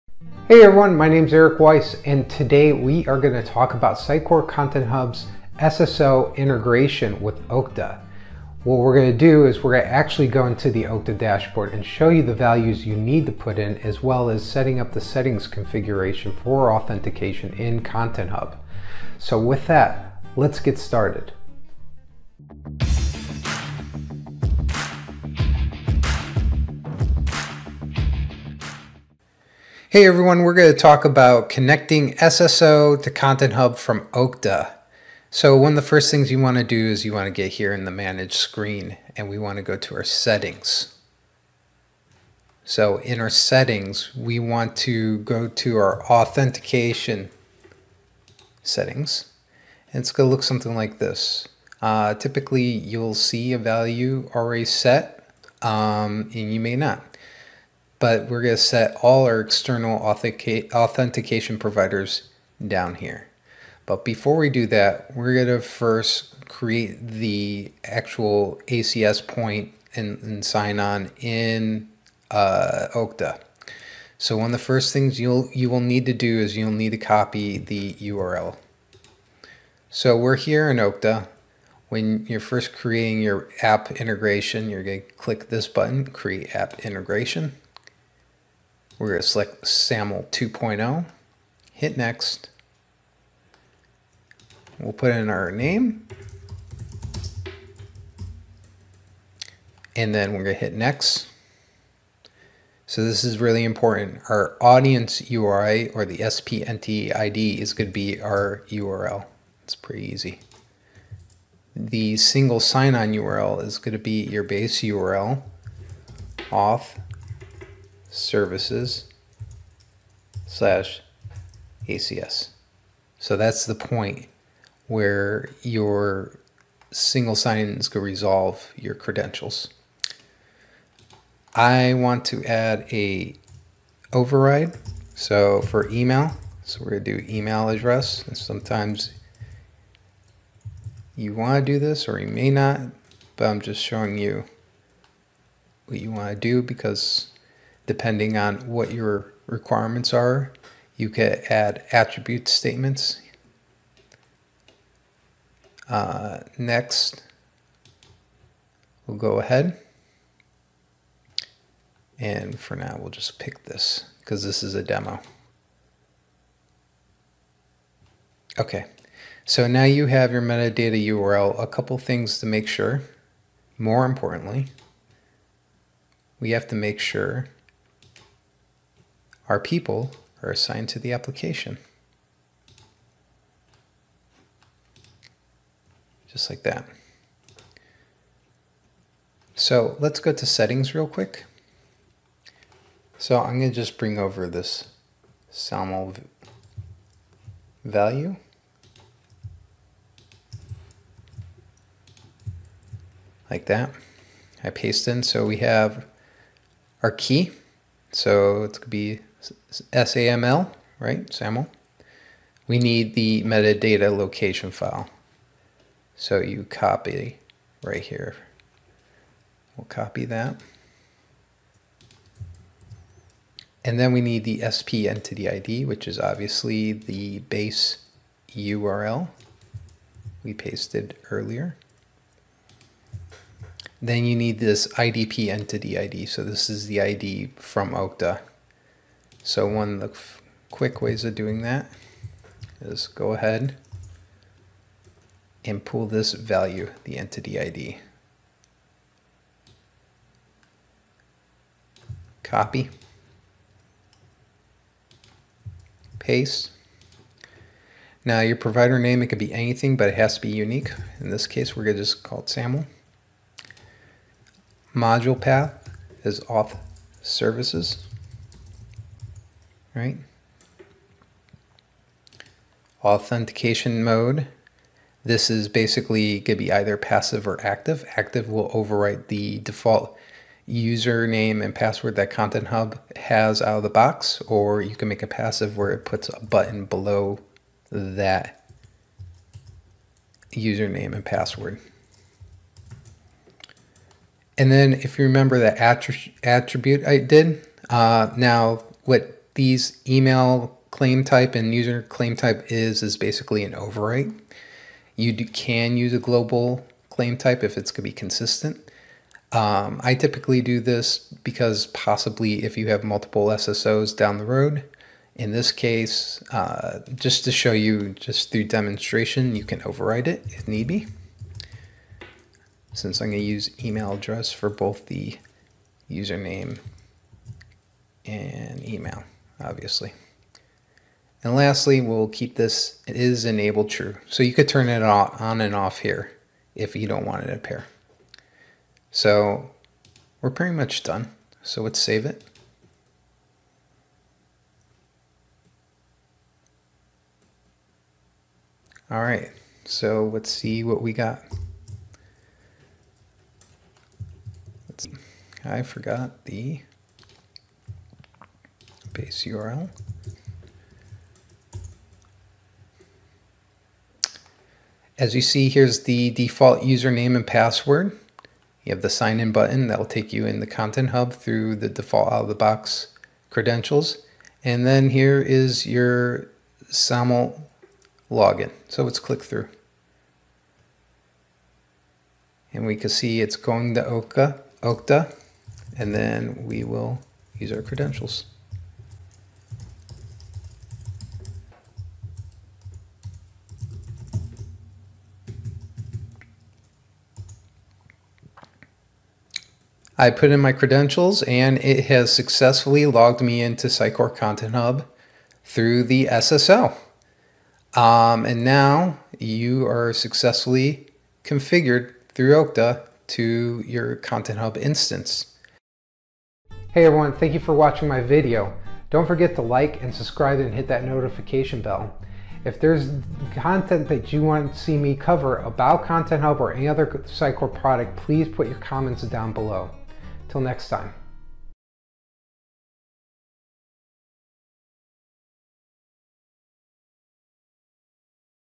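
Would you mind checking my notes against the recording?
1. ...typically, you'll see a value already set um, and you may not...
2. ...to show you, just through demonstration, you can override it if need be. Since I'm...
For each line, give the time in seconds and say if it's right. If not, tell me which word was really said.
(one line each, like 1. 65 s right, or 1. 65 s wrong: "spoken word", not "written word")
1. 52 s right
2. 317 s right.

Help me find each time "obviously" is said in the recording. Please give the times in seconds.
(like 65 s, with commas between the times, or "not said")
226 s, 329 s.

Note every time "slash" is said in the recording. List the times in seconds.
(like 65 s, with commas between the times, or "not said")
120 s.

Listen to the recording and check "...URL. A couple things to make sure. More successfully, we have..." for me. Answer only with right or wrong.
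wrong.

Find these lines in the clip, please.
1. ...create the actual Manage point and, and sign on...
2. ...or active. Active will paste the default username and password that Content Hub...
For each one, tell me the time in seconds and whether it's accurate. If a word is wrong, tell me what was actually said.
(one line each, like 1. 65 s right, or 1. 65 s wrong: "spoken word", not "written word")
1. 66 s wrong: "ACS", not "Manage"
2. 277 s wrong: "overwrite", not "paste".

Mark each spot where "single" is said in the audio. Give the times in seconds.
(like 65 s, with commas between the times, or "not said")
112 s, 126 s.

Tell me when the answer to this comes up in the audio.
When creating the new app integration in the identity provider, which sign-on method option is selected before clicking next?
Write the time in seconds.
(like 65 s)
89 s.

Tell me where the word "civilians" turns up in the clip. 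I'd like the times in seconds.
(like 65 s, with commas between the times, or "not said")
not said.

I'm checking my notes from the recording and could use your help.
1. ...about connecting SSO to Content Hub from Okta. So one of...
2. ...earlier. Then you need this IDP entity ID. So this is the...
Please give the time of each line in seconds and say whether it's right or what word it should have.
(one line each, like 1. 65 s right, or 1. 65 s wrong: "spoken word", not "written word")
1. 31 s right
2. 231 s right.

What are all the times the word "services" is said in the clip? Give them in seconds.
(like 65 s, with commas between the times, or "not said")
118 s, 267 s.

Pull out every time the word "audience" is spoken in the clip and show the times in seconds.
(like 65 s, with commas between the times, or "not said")
104 s.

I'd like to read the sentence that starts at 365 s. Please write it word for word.
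As you see, here's the default username and password.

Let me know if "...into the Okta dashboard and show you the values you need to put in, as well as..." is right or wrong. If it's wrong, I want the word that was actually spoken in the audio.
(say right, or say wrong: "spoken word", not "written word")
right.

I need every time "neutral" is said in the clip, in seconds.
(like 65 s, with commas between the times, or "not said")
not said.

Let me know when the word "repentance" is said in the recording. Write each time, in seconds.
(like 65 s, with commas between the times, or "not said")
not said.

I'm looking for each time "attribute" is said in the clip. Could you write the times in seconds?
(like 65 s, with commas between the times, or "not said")
151 s, 296 s.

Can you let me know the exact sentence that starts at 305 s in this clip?
You do, can use a global claim type if it's going to be consistent.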